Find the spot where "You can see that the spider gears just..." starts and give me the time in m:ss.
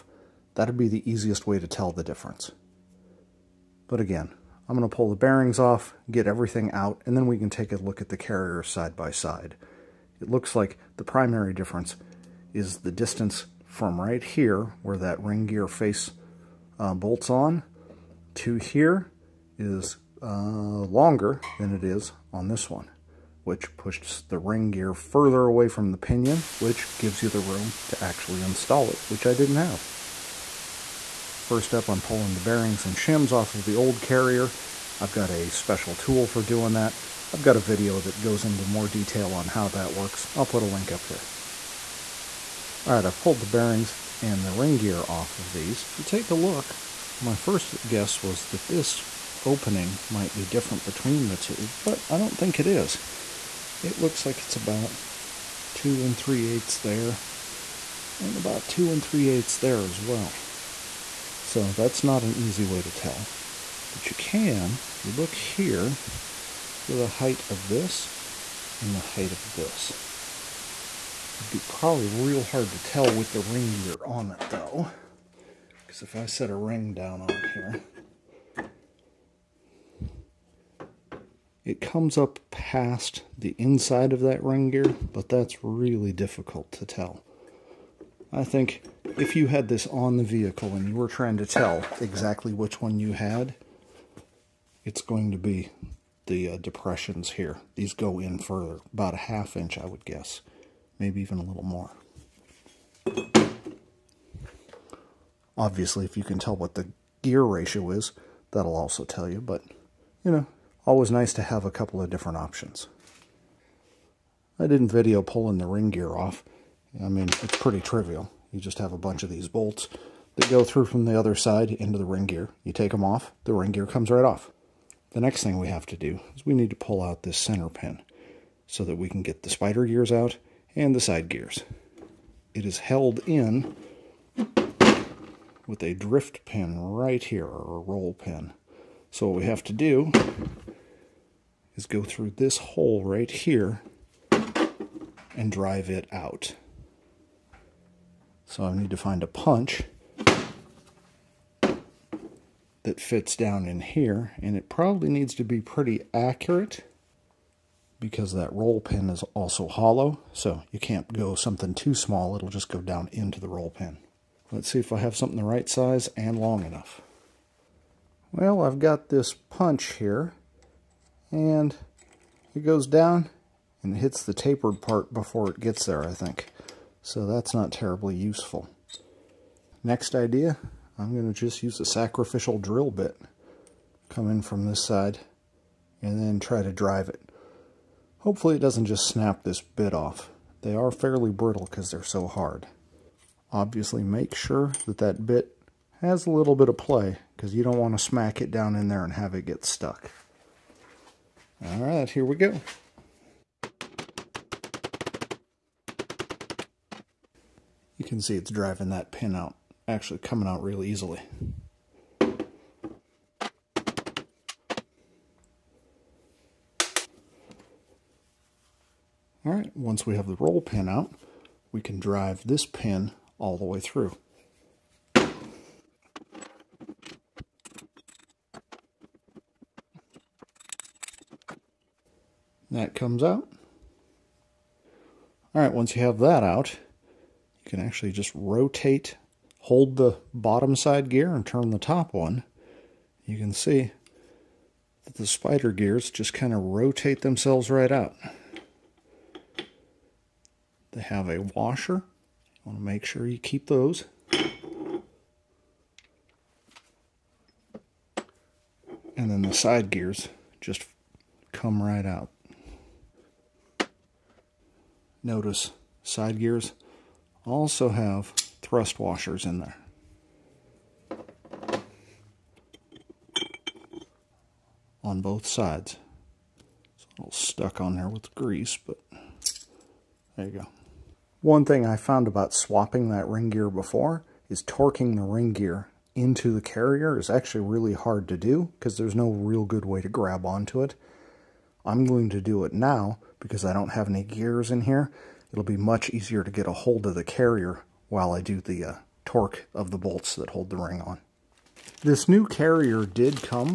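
4:03.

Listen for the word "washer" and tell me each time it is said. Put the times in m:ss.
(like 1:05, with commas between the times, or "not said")
4:11, 4:28.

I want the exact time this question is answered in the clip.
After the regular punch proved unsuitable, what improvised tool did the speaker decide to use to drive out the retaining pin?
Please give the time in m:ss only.
3:01.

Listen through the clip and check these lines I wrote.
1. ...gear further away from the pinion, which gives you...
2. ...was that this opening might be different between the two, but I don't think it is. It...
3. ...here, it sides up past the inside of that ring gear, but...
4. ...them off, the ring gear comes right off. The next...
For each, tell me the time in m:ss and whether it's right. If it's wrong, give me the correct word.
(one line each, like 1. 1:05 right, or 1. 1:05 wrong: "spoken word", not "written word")
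1. 0:24 right
2. 0:48 right
3. 1:17 wrong: "comes", not "sides"
4. 2:02 right.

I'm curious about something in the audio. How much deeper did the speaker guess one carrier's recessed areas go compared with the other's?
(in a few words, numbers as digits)
half inch.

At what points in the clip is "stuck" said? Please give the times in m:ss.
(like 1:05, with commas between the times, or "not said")
3:19, 4:37.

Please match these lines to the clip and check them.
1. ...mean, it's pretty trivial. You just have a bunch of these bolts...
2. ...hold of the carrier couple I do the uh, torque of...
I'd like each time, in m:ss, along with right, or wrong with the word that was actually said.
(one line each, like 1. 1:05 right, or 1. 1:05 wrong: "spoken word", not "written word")
1. 1:57 right
2. 4:56 wrong: "while", not "couple".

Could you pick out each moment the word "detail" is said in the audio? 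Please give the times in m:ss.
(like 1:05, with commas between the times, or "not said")
0:38.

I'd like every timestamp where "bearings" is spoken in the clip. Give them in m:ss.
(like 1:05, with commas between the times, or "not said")
0:05, 0:32, 0:43.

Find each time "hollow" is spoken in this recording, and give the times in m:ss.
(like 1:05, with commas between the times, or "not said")
2:39.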